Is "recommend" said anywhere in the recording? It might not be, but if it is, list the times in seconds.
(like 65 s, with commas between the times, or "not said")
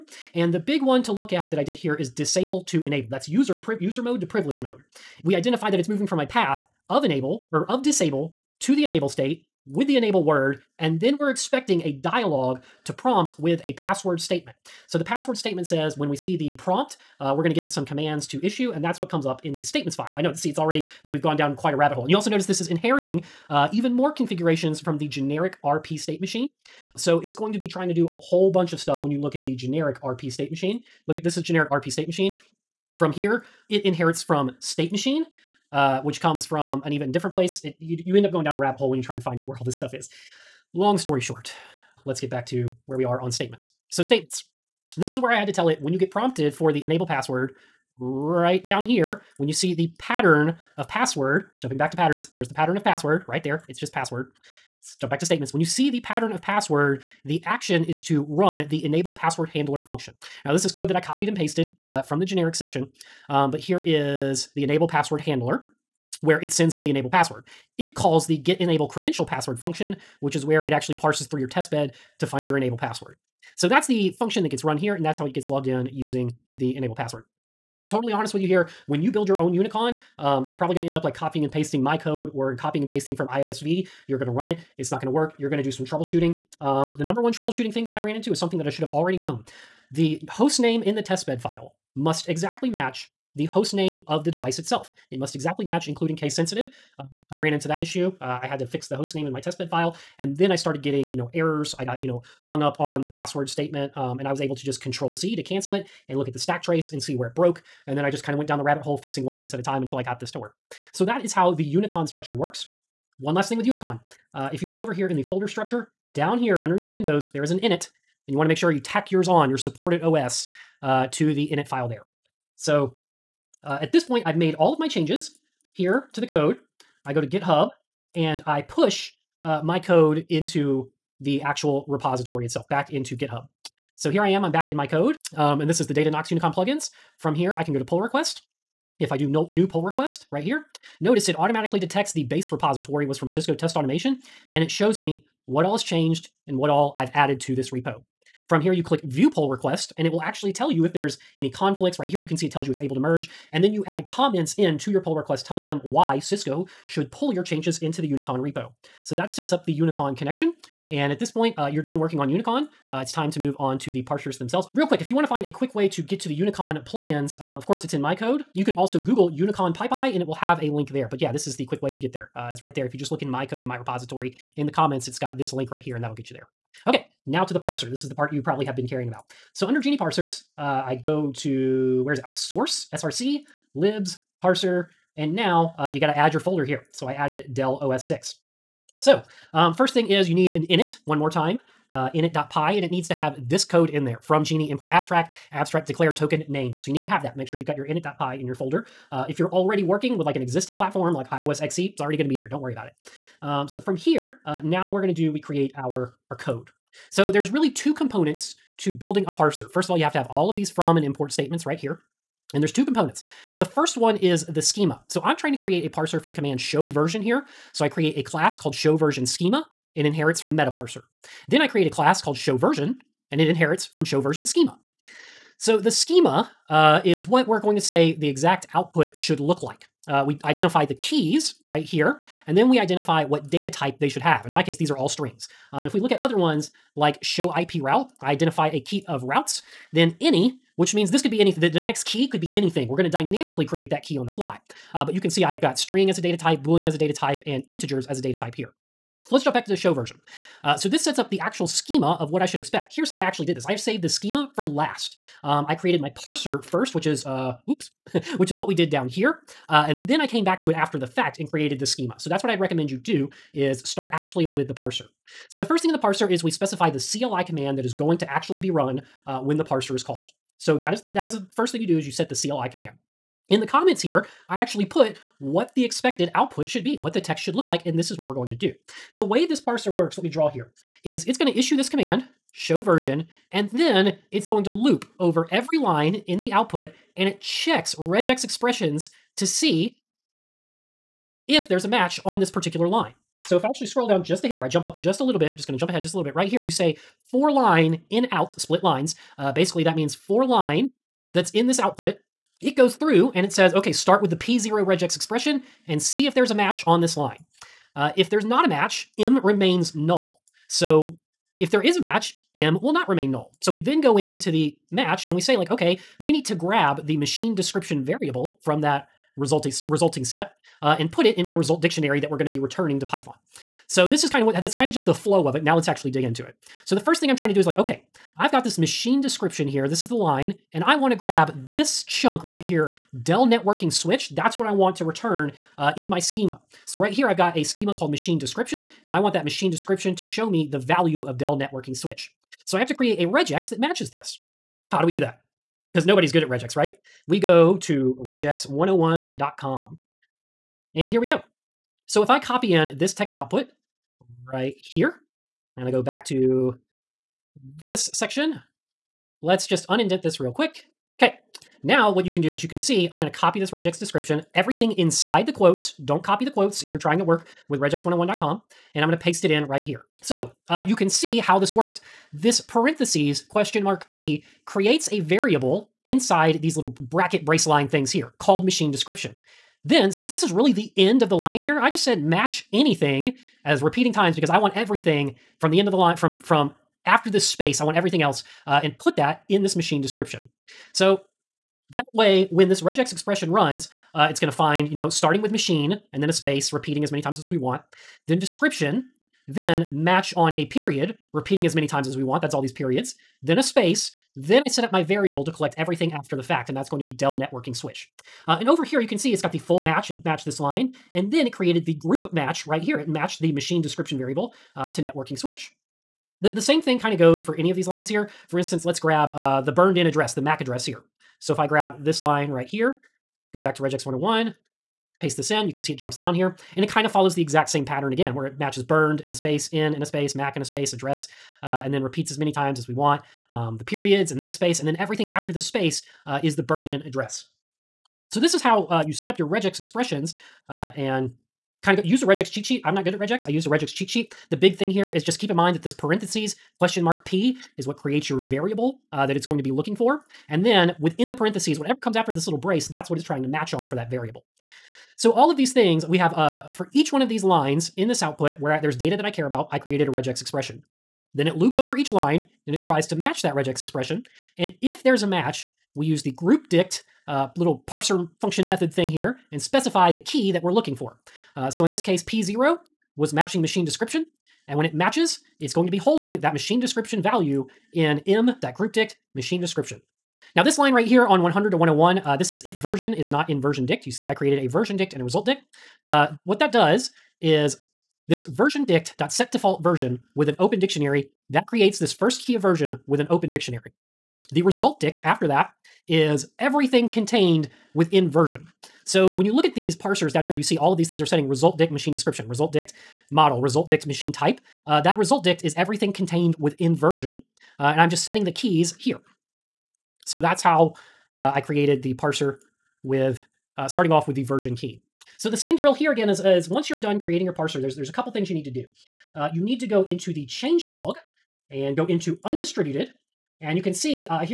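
262 s.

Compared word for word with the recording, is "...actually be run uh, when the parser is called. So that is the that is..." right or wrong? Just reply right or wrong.
right.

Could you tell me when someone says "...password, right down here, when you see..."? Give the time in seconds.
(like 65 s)
47 s.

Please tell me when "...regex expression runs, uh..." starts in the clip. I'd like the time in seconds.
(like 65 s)
392 s.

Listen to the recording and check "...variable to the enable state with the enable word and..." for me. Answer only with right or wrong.
wrong.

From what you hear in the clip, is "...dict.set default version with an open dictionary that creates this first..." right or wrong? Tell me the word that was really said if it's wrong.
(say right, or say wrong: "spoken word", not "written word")
right.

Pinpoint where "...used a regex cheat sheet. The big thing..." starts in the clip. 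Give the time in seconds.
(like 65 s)
443 s.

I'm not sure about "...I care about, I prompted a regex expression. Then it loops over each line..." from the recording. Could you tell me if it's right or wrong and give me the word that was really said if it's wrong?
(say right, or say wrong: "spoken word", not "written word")
wrong: "created", not "prompted".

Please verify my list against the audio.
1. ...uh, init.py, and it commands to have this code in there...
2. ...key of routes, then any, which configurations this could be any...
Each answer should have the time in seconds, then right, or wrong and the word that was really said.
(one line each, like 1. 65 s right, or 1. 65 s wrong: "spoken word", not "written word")
1. 191 s wrong: "needs", not "commands"
2. 238 s wrong: "means", not "configurations".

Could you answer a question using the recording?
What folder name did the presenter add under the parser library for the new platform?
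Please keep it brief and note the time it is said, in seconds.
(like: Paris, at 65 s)
Dell OS 6, at 187 s.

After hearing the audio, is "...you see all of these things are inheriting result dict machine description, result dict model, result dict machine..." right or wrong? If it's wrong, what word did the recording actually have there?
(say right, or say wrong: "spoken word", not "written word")
wrong: "setting", not "inheriting".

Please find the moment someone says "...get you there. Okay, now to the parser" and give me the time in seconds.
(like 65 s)
176 s.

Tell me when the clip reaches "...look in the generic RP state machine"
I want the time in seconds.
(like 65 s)
29 s.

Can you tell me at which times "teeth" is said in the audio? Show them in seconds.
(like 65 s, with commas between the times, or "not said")
not said.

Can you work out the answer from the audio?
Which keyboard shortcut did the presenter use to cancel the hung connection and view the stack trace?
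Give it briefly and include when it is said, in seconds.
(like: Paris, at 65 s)
Control C, at 104 s.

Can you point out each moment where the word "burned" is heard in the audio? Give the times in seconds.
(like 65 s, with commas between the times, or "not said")
419 s, 428 s, 436 s.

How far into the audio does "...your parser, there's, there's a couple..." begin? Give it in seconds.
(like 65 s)
517 s.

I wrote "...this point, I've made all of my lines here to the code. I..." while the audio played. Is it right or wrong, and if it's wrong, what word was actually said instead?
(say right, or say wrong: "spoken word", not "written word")
wrong: "changes", not "lines".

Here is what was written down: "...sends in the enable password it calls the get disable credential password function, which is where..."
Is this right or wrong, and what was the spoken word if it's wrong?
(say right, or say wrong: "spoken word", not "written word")
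wrong: "enable", not "disable".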